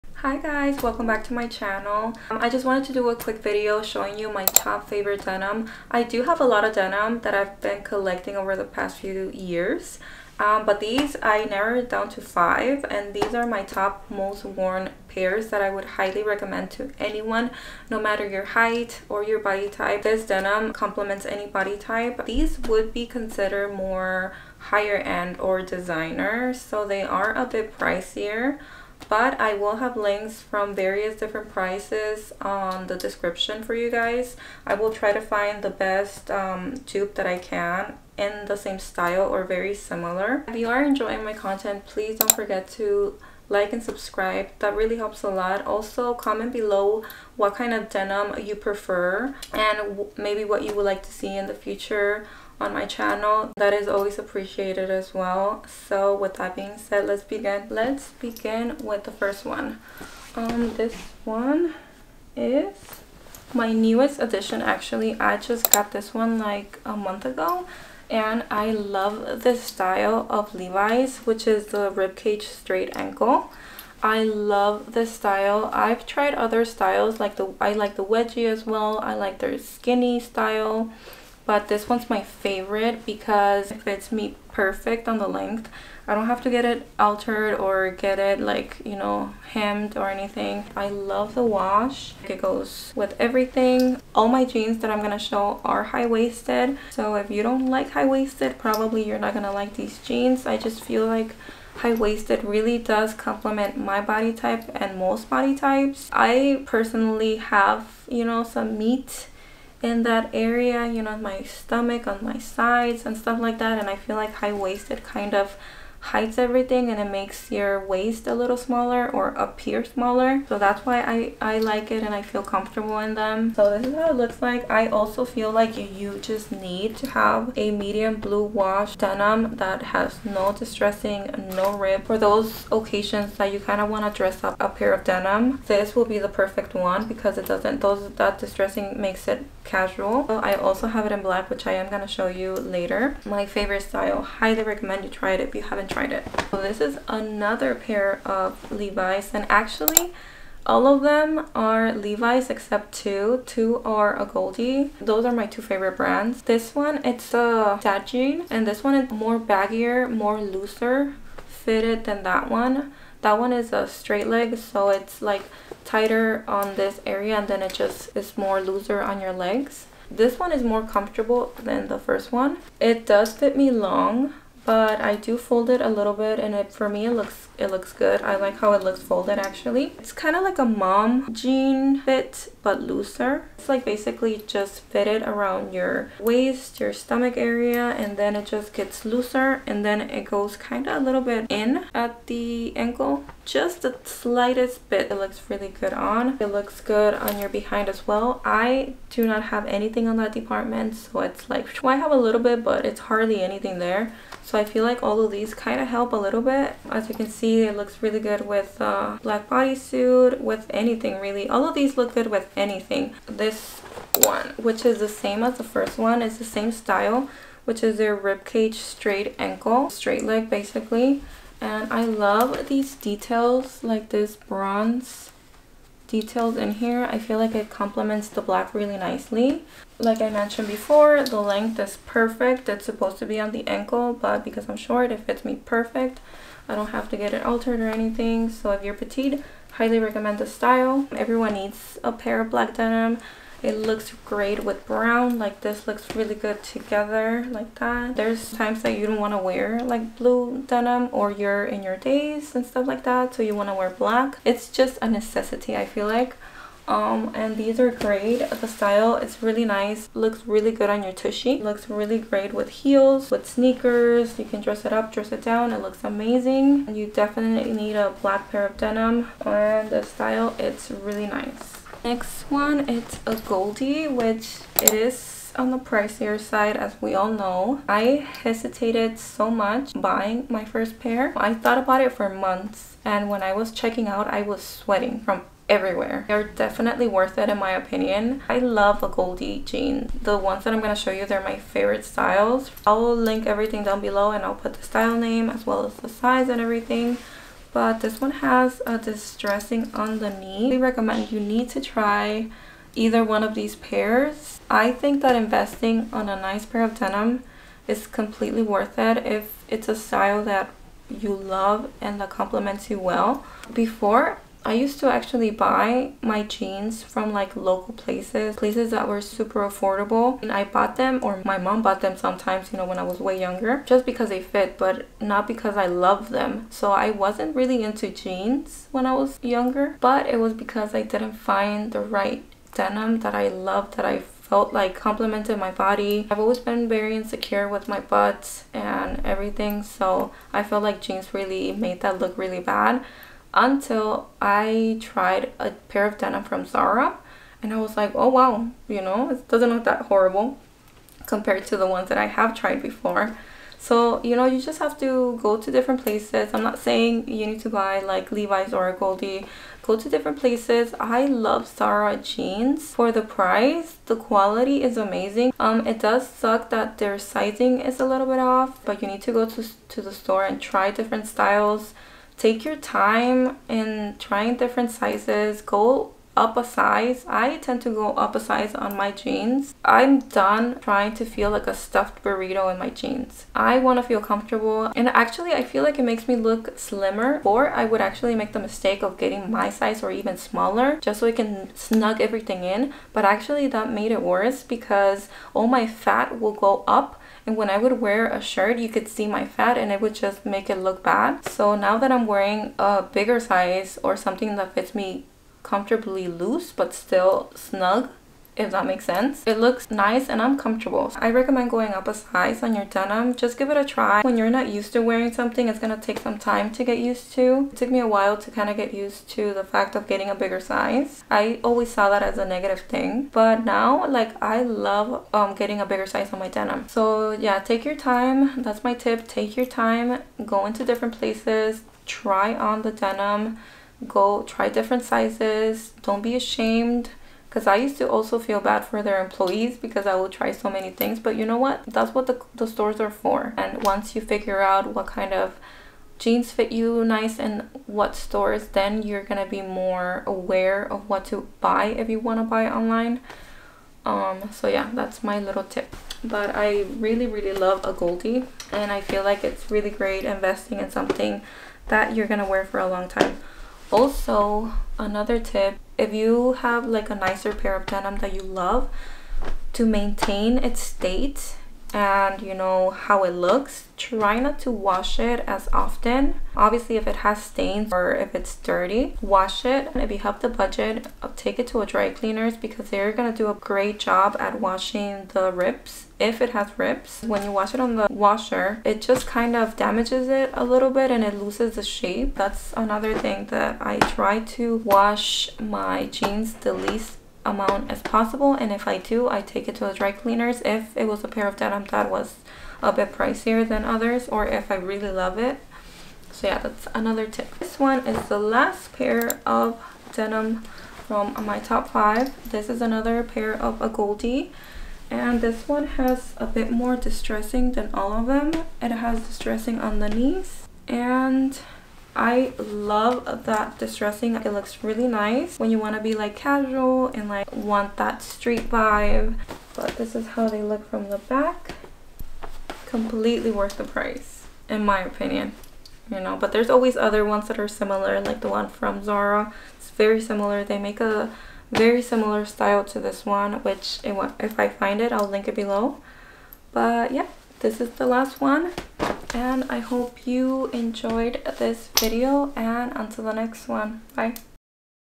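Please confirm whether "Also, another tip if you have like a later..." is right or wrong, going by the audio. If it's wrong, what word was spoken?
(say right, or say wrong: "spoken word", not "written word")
wrong: "nicer", not "later".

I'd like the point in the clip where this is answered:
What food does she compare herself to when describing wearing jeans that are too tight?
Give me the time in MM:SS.
06:21.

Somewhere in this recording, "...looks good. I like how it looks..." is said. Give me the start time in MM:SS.
02:57.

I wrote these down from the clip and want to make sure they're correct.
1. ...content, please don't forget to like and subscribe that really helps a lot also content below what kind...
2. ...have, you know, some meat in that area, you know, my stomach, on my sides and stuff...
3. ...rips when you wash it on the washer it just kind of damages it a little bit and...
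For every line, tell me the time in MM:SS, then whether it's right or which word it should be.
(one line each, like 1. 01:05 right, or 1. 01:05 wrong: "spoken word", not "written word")
1. 00:41 wrong: "comment", not "content"
2. 01:47 right
3. 08:06 right.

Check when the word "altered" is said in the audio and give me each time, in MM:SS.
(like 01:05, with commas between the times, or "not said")
01:26, 03:57.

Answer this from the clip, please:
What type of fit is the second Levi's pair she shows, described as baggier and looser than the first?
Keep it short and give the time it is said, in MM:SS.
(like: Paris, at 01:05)
Dad jean, at 02:37.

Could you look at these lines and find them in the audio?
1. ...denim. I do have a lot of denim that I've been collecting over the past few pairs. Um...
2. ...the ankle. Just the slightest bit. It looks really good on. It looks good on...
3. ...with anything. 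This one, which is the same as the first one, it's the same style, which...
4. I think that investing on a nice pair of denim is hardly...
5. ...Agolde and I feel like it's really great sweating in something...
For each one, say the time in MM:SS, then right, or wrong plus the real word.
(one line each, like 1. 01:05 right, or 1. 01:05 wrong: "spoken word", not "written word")
1. 00:05 wrong: "years", not "pairs"
2. 03:12 right
3. 03:32 right
4. 05:04 wrong: "completely", not "hardly"
5. 07:37 wrong: "investing", not "sweating".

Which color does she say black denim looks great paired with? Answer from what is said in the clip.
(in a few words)
Brown.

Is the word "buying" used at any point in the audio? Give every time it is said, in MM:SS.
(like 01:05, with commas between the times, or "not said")
04:39.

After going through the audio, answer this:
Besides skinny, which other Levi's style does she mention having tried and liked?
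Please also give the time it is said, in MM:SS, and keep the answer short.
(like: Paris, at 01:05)
Wedgie, at 01:17.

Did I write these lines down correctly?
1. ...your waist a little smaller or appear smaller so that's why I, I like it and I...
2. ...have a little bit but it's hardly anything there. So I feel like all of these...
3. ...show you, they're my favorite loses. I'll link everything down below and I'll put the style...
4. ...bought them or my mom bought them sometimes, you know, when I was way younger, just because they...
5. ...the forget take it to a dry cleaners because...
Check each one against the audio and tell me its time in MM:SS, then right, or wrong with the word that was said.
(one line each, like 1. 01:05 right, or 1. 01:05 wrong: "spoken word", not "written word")
1. 01:57 right
2. 03:21 right
3. 04:51 wrong: "styles", not "loses"
4. 05:20 right
5. 08:00 wrong: "budget", not "forget".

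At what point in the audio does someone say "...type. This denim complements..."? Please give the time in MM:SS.
00:19.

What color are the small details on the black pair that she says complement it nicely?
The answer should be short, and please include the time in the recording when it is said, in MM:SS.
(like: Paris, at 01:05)
Bronze, at 03:44.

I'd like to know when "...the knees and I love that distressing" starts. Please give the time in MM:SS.
08:39.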